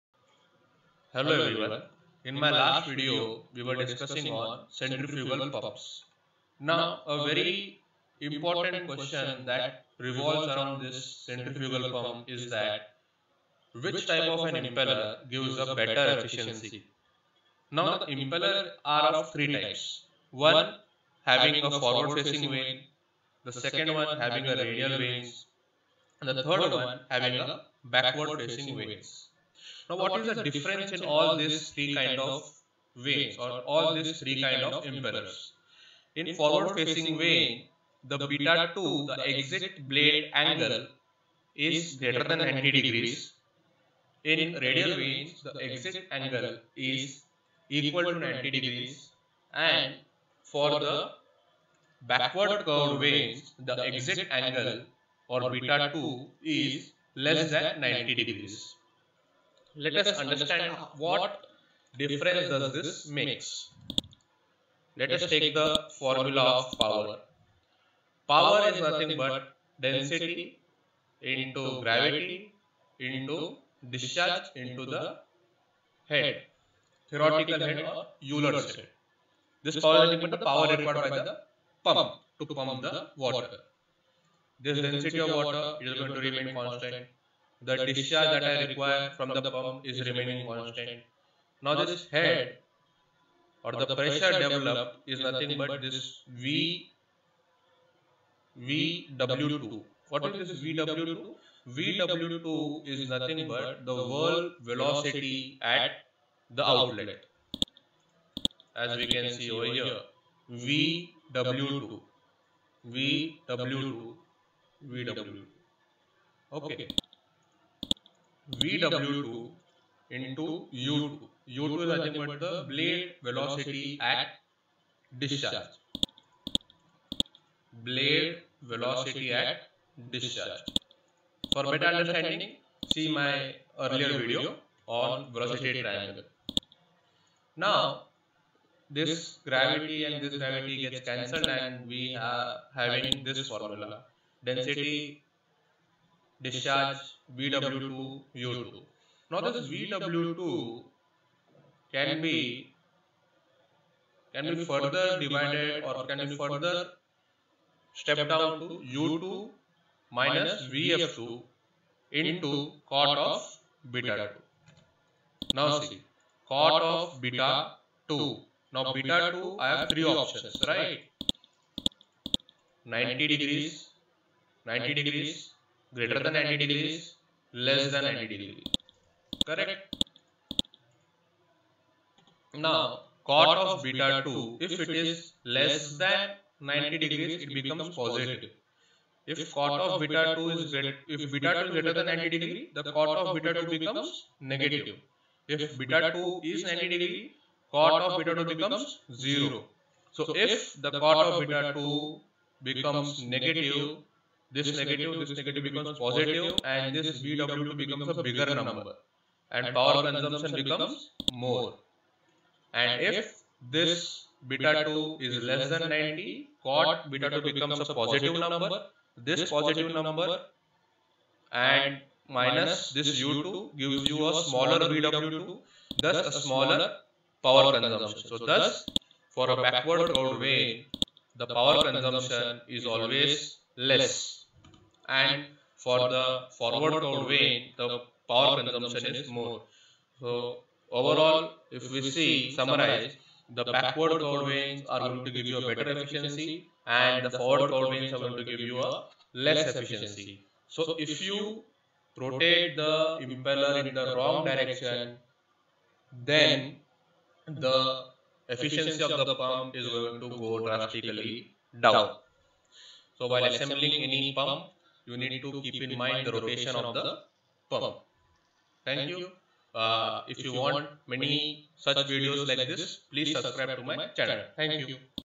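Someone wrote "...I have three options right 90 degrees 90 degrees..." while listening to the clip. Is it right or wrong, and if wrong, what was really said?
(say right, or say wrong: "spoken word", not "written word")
right.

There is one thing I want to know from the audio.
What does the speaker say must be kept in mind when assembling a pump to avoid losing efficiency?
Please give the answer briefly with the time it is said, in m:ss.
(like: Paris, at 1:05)
rotation of the pump, at 4:26.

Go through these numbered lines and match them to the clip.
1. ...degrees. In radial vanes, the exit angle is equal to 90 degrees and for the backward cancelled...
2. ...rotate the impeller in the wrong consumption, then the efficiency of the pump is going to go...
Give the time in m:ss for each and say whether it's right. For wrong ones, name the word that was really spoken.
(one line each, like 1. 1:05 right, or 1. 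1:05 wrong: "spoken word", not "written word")
1. 0:42 wrong: "curved", not "cancelled"
2. 4:12 wrong: "direction", not "consumption".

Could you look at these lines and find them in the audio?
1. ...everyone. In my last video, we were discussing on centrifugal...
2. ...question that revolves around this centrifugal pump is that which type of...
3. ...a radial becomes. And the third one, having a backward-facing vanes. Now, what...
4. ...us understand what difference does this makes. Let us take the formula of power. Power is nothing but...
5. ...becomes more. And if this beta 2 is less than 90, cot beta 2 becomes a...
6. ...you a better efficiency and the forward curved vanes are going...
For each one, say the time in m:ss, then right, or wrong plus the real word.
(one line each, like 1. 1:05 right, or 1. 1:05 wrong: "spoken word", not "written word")
1. 0:01 right
2. 0:08 right
3. 0:24 wrong: "vanes", not "becomes"
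4. 1:00 right
5. 3:30 right
6. 4:05 right.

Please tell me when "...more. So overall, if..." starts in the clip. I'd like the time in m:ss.
3:59.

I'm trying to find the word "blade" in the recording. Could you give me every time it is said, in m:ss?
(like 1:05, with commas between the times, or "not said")
0:39, 2:02, 2:07.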